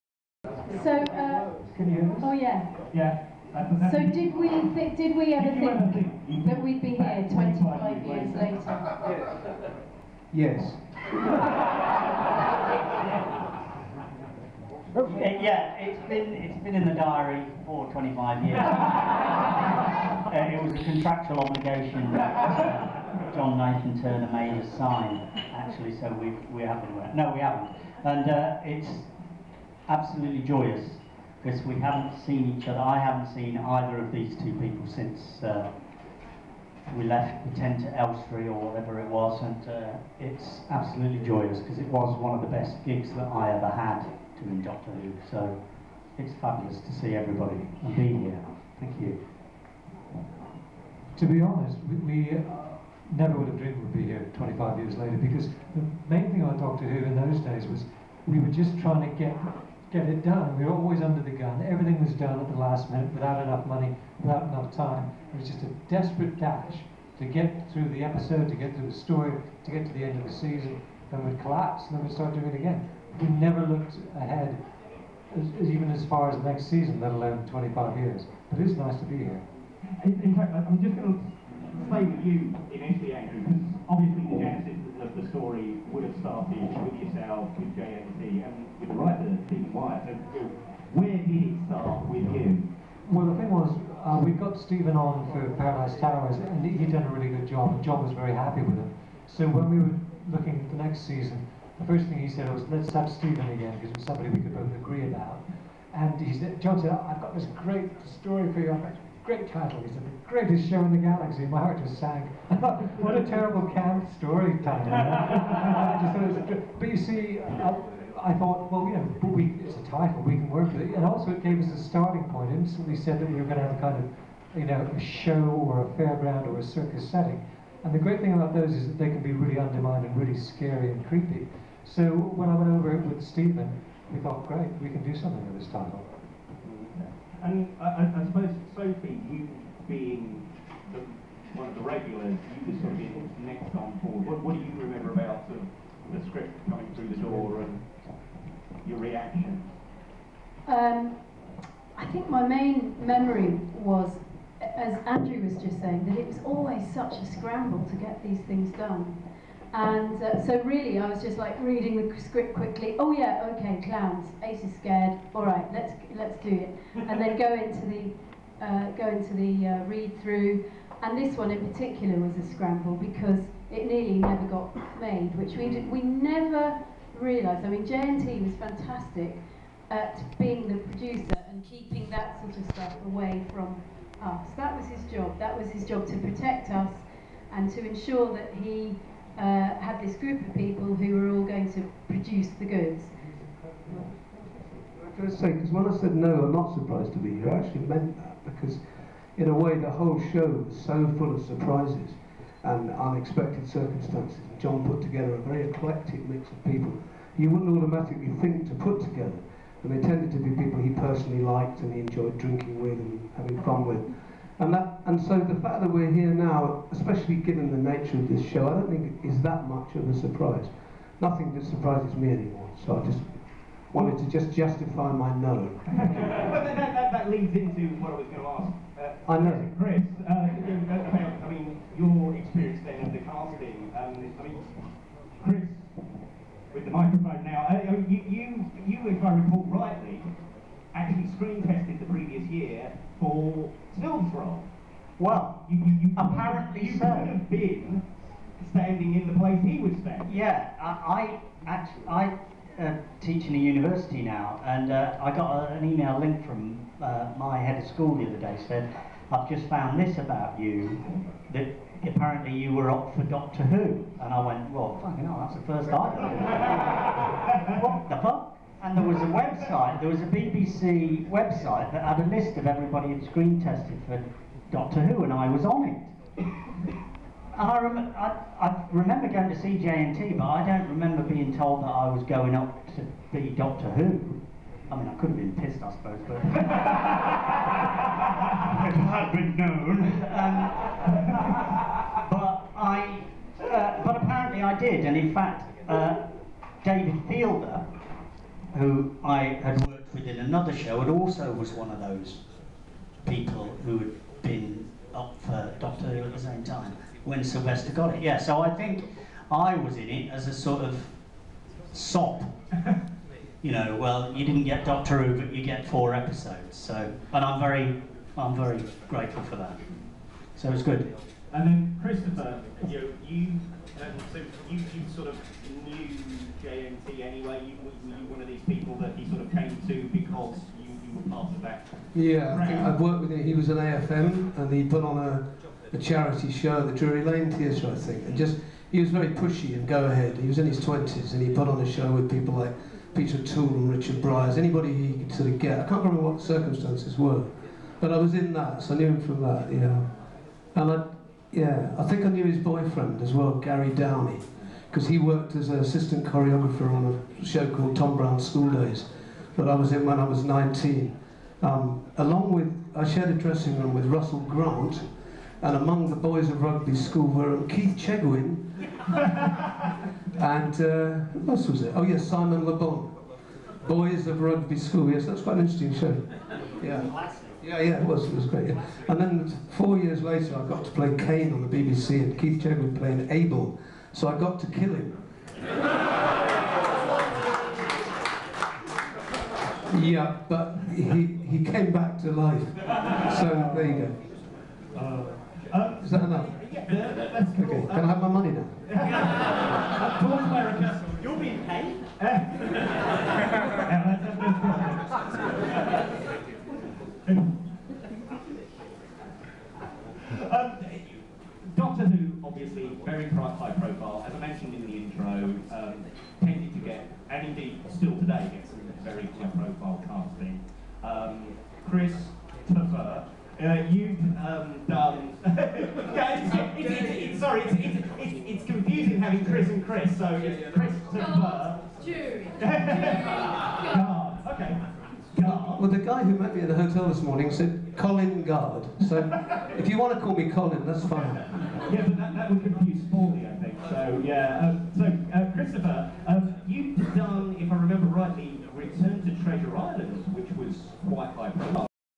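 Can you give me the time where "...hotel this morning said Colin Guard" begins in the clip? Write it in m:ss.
7:16.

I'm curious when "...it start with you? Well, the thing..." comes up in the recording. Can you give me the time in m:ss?
1:31.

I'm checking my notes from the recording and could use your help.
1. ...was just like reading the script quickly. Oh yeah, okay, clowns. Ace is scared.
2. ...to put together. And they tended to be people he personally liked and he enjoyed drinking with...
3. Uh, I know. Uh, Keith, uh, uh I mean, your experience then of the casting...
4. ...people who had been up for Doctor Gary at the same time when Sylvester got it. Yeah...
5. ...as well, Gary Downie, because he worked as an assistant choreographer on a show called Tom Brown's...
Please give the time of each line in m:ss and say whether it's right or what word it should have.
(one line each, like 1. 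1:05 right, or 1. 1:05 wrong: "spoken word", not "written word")
1. 2:41 right
2. 3:28 right
3. 3:49 wrong: "Chris", not "Keith"
4. 5:03 wrong: "Who", not "Gary"
5. 5:53 right.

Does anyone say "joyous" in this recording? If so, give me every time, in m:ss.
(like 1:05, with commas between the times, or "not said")
0:30, 0:41.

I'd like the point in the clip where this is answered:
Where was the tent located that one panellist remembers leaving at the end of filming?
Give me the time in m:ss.
0:37.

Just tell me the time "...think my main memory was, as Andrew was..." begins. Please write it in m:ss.
2:32.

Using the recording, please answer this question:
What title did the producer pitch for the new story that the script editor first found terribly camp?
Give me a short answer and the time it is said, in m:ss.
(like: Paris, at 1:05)
The Greatest Show in the Galaxy, at 1:50.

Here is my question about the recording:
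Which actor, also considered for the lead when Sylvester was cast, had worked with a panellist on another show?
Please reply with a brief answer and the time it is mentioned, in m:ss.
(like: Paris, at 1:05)
David Fielder, at 4:56.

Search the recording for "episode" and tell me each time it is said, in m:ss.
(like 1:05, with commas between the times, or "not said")
1:08, 5:16.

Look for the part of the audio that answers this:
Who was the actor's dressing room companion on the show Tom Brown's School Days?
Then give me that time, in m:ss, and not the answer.
6:04.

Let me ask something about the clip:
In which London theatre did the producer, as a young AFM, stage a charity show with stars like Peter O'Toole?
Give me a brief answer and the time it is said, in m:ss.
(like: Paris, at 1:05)
Drury Lane Theatre, at 5:36.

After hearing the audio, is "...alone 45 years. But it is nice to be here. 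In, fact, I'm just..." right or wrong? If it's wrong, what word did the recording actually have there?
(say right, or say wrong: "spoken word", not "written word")
wrong: "25", not "45".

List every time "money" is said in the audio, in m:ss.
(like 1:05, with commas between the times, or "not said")
1:03, 6:38.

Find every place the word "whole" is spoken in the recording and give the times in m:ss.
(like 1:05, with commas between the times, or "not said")
3:19.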